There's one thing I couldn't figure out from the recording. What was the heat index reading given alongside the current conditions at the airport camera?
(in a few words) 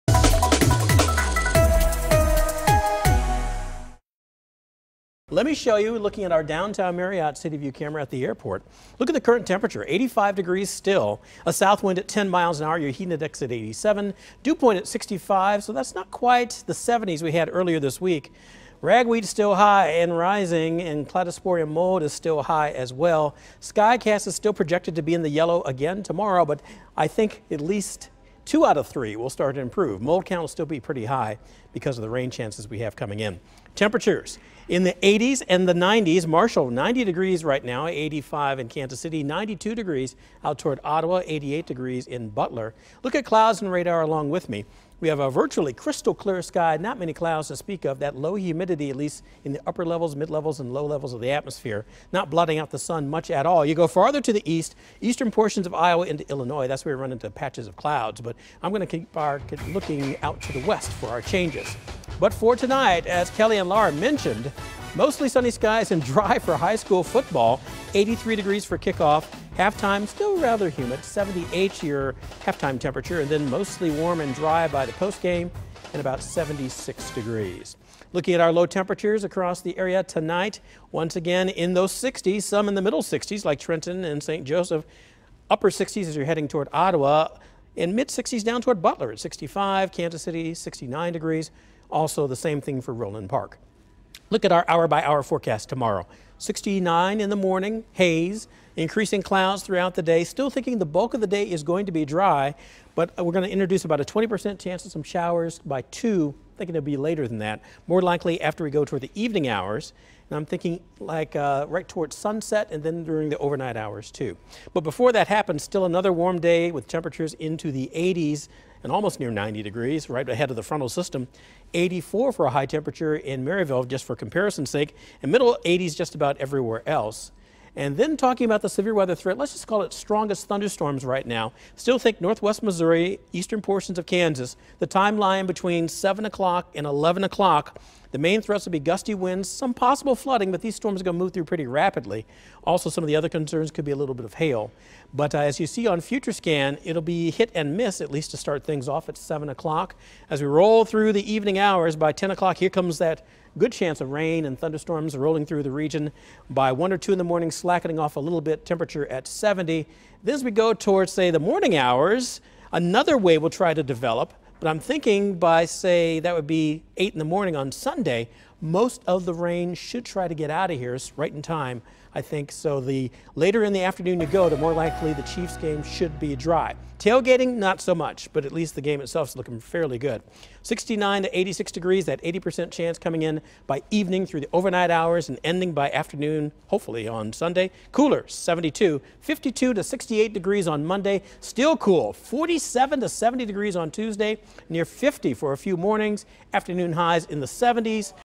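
87.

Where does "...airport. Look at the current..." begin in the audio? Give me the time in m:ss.
0:08.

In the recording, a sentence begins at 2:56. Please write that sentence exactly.
Tailgating, not so much, but at least the game itself is looking fairly good.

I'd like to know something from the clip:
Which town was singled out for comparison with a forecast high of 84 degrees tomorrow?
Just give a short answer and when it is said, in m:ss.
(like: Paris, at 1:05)
Maryville, at 2:03.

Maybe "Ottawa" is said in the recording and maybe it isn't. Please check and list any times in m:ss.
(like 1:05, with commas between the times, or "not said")
0:40, 1:26.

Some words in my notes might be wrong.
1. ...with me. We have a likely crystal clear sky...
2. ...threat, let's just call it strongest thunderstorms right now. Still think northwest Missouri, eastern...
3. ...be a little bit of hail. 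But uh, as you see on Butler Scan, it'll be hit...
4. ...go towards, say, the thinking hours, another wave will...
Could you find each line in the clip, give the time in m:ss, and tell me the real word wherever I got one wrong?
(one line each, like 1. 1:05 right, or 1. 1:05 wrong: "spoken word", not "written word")
1. 0:44 wrong: "virtually", not "likely"
2. 2:09 right
3. 2:23 wrong: "Future", not "Butler"
4. 2:40 wrong: "morning", not "thinking".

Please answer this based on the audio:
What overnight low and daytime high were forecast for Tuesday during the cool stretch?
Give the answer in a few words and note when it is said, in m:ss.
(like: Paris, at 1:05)
47 to 70, at 3:12.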